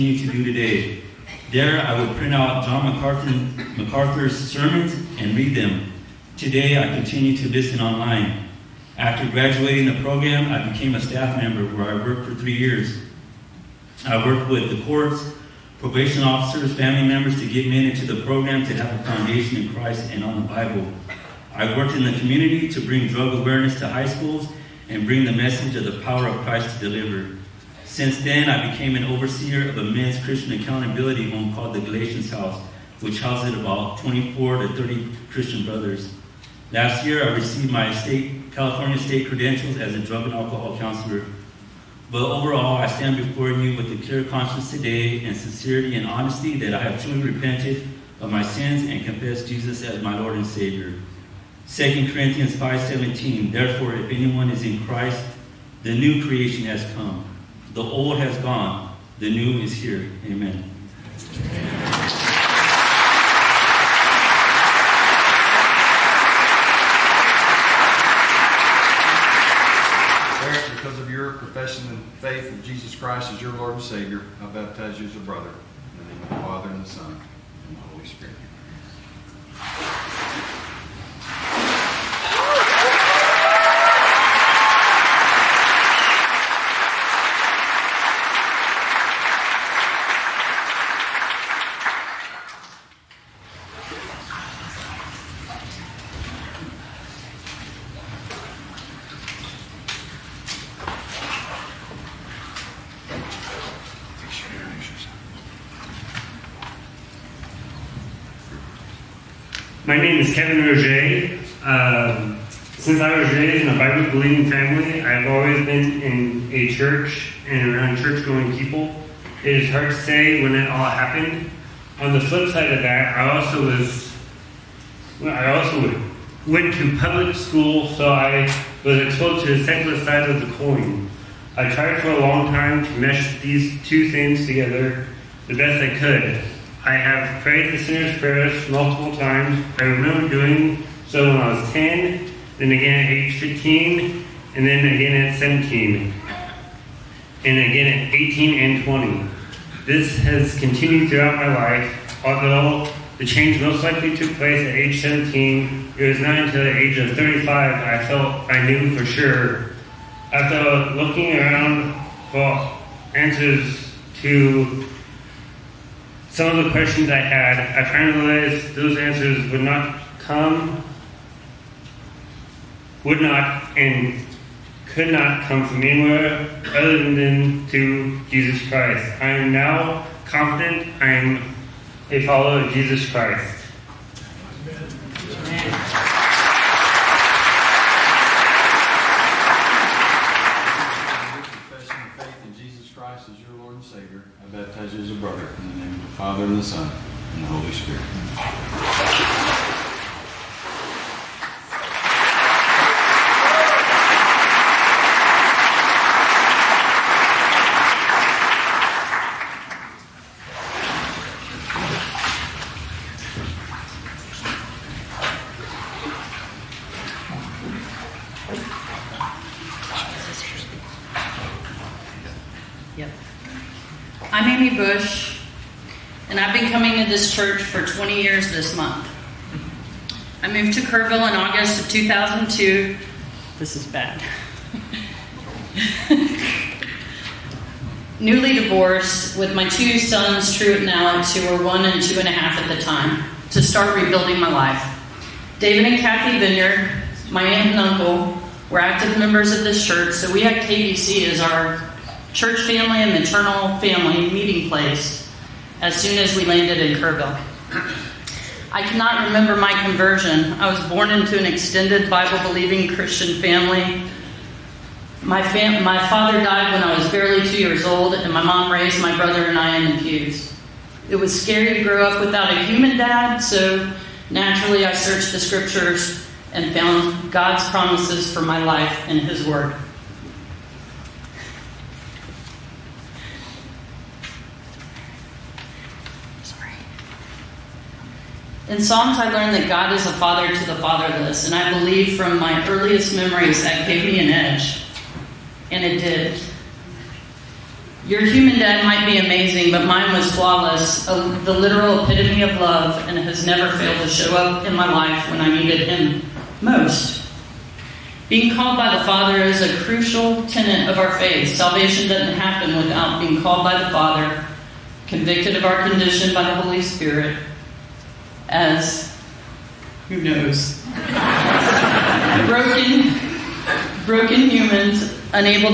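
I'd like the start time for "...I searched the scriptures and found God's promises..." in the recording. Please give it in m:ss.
4:34.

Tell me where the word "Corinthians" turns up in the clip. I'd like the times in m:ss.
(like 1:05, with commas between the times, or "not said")
0:52.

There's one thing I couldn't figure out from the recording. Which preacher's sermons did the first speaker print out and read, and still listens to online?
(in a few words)
John MacArthur.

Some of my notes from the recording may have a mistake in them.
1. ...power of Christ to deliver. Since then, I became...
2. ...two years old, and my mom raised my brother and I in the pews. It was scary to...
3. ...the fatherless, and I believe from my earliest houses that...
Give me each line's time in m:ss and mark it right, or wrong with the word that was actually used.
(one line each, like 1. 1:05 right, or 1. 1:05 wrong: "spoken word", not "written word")
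1. 0:26 right
2. 4:27 right
3. 4:50 wrong: "memories", not "houses".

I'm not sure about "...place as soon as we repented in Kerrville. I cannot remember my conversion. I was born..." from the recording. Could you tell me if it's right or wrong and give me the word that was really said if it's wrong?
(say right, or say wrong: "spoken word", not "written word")
wrong: "landed", not "repented".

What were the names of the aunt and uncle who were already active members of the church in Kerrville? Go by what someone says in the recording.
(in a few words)
David and Kathy Vineyard.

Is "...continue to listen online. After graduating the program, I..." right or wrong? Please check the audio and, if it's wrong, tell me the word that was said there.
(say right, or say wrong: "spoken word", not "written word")
right.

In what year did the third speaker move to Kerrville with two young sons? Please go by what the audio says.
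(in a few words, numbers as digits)
2002.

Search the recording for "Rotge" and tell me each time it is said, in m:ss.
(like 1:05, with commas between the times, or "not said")
1:50.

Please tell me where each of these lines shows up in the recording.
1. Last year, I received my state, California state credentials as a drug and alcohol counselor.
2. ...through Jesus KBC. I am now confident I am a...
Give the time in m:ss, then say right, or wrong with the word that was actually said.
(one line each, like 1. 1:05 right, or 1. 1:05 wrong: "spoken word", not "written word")
1. 0:36 right
2. 2:57 wrong: "Christ", not "KBC".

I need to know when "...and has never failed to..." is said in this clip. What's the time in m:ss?
5:03.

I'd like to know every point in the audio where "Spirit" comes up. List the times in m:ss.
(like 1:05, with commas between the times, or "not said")
1:18, 3:17, 5:16.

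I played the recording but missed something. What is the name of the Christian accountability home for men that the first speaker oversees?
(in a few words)
Galatians House.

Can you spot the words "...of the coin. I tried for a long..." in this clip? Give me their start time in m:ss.
2:10.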